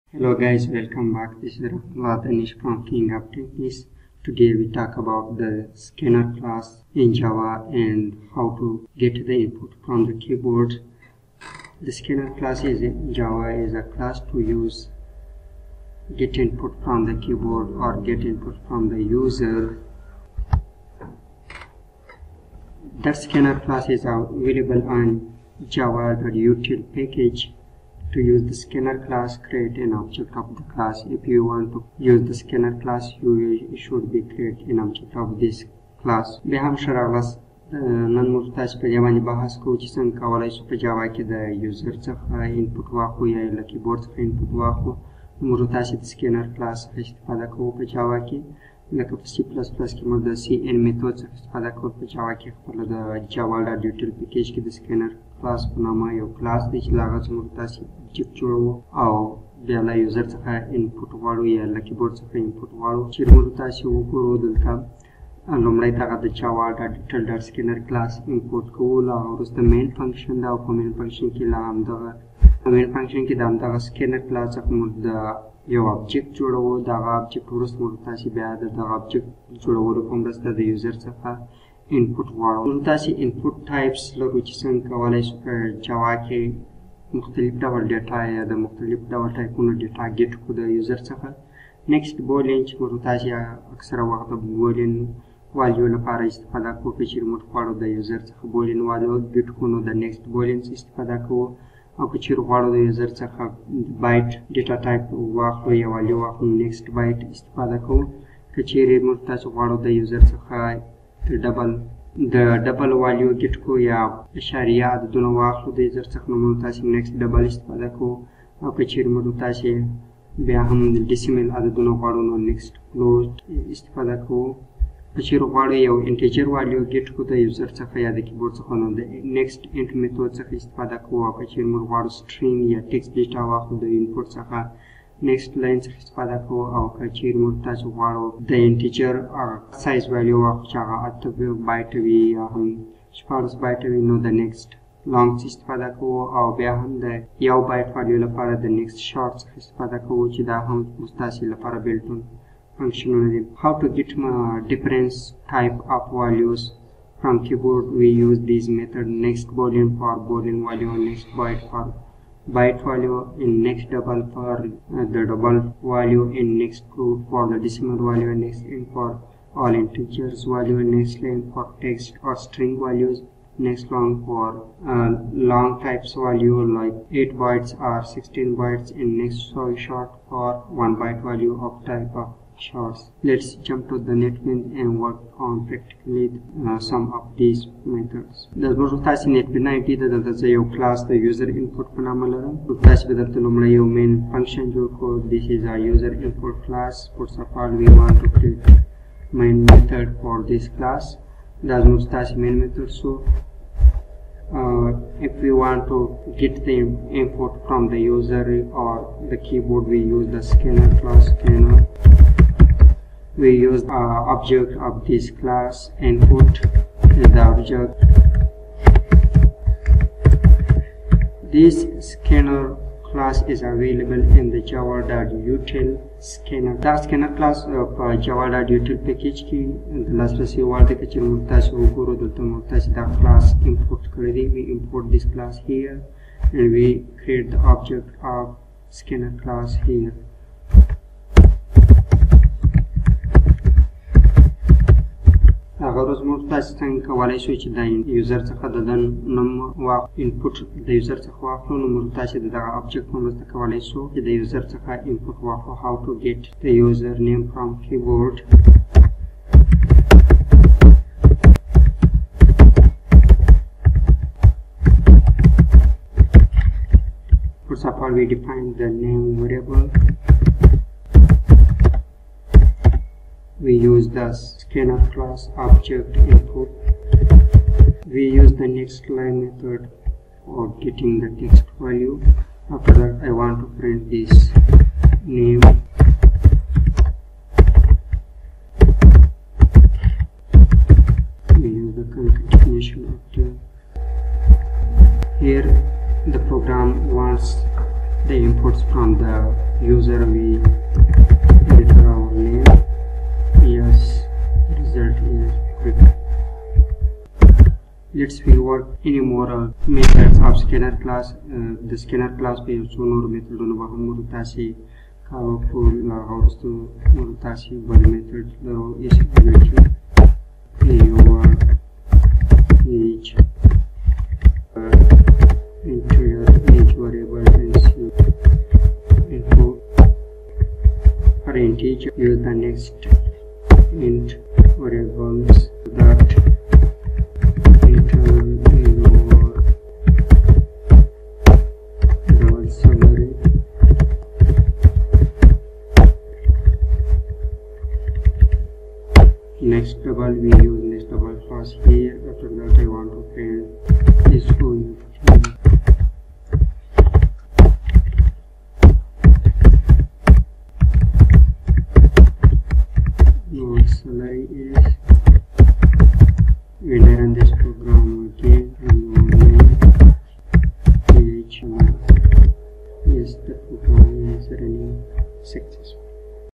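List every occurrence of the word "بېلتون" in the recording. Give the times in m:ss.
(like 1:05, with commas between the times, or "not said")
2:31.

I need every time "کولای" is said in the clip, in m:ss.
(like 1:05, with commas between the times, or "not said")
0:40, 4:07, 4:13.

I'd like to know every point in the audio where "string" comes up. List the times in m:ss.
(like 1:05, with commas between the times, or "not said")
2:52.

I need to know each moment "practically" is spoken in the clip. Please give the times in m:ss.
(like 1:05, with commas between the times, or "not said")
3:05.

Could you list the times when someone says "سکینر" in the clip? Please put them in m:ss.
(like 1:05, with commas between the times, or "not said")
0:46, 0:54, 1:07, 1:13.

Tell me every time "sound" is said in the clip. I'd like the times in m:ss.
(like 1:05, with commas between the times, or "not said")
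not said.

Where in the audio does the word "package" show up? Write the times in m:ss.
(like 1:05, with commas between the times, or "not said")
0:26, 3:49.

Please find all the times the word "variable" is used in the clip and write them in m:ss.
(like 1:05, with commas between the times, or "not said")
4:29, 5:26, 5:34.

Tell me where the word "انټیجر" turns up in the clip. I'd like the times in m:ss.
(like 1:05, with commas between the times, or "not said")
2:06, 2:18.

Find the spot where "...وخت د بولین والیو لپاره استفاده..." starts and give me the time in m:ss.
1:34.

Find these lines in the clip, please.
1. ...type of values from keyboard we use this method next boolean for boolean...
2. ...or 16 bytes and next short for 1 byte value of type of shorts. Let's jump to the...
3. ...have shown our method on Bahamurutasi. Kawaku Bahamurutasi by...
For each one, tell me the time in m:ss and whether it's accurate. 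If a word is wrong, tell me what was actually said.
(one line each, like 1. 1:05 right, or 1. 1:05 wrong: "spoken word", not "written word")
1. 2:35 right
2. 2:57 right
3. 5:12 wrong: "Murutasi", not "Bahamurutasi".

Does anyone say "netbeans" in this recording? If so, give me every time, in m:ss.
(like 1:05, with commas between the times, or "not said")
3:04, 3:09.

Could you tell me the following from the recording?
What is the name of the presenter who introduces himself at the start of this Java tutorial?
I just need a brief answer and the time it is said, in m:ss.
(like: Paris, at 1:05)
Ratanish, at 0:02.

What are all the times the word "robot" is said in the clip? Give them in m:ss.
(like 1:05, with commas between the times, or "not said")
not said.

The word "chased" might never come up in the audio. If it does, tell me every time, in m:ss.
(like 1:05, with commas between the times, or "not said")
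not said.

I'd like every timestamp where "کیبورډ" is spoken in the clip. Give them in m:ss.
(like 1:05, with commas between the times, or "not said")
0:43, 1:01, 2:08, 4:17.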